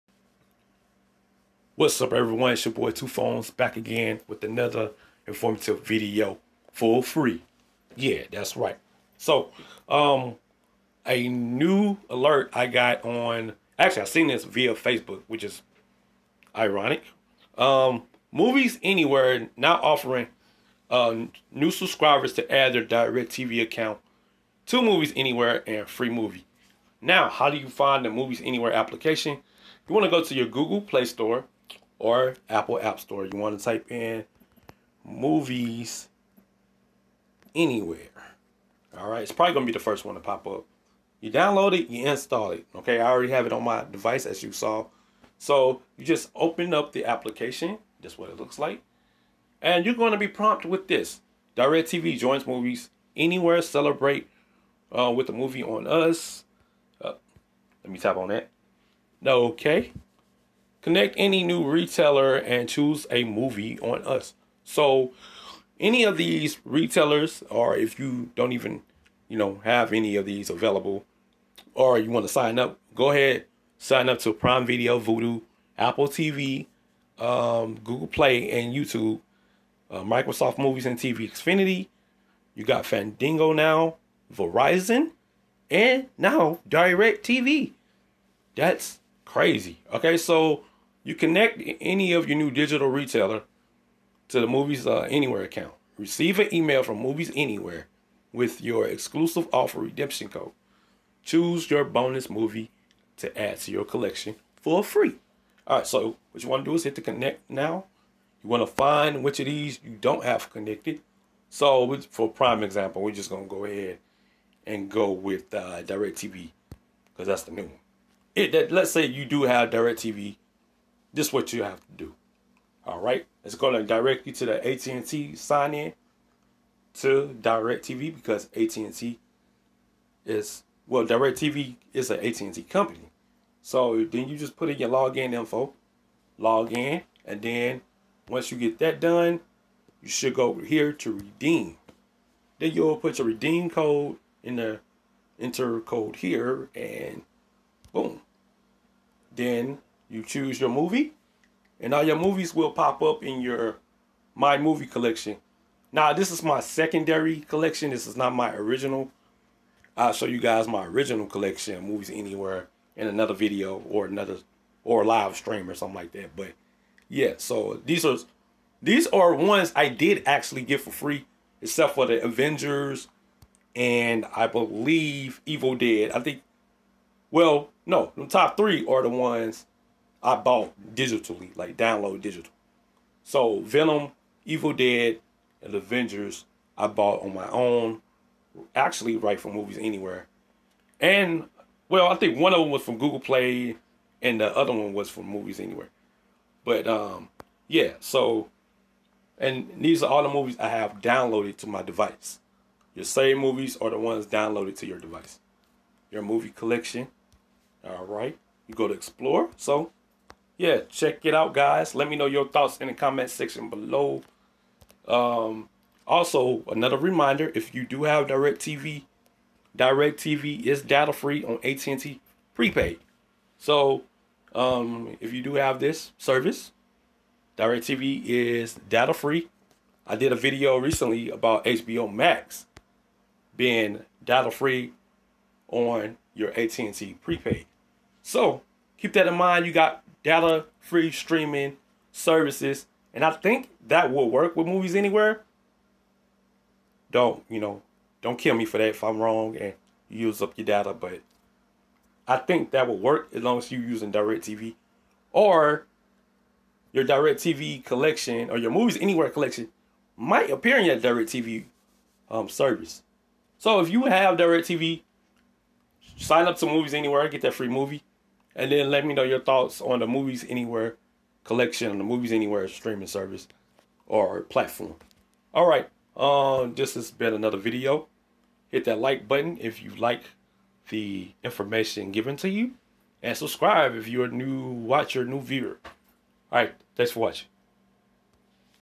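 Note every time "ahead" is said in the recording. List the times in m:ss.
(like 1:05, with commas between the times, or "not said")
1:13, 1:53.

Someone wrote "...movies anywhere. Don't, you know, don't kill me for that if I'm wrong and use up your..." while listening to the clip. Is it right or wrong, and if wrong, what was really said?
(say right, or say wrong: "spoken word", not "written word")
right.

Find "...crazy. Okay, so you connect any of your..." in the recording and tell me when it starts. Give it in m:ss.
1:29.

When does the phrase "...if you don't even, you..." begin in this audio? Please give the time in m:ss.
1:07.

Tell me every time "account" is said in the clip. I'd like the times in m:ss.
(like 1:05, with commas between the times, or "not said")
0:23, 1:35.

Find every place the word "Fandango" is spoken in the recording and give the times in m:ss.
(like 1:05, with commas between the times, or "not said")
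1:22.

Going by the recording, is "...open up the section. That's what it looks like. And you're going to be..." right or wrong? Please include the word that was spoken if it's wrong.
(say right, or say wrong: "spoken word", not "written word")
wrong: "application", not "section".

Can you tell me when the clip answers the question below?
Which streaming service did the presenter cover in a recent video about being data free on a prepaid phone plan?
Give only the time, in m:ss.
3:51.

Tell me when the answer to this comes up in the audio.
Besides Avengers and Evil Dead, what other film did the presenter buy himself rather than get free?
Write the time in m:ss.
3:03.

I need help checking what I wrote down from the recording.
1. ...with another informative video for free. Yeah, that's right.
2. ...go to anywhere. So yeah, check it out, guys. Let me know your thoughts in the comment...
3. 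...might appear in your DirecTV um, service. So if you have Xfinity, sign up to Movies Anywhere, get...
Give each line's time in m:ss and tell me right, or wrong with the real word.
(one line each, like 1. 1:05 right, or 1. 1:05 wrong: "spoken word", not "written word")
1. 0:04 right
2. 3:28 wrong: "explore", not "anywhere"
3. 4:20 wrong: "DirecTV", not "Xfinity".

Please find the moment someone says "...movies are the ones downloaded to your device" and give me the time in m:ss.
3:23.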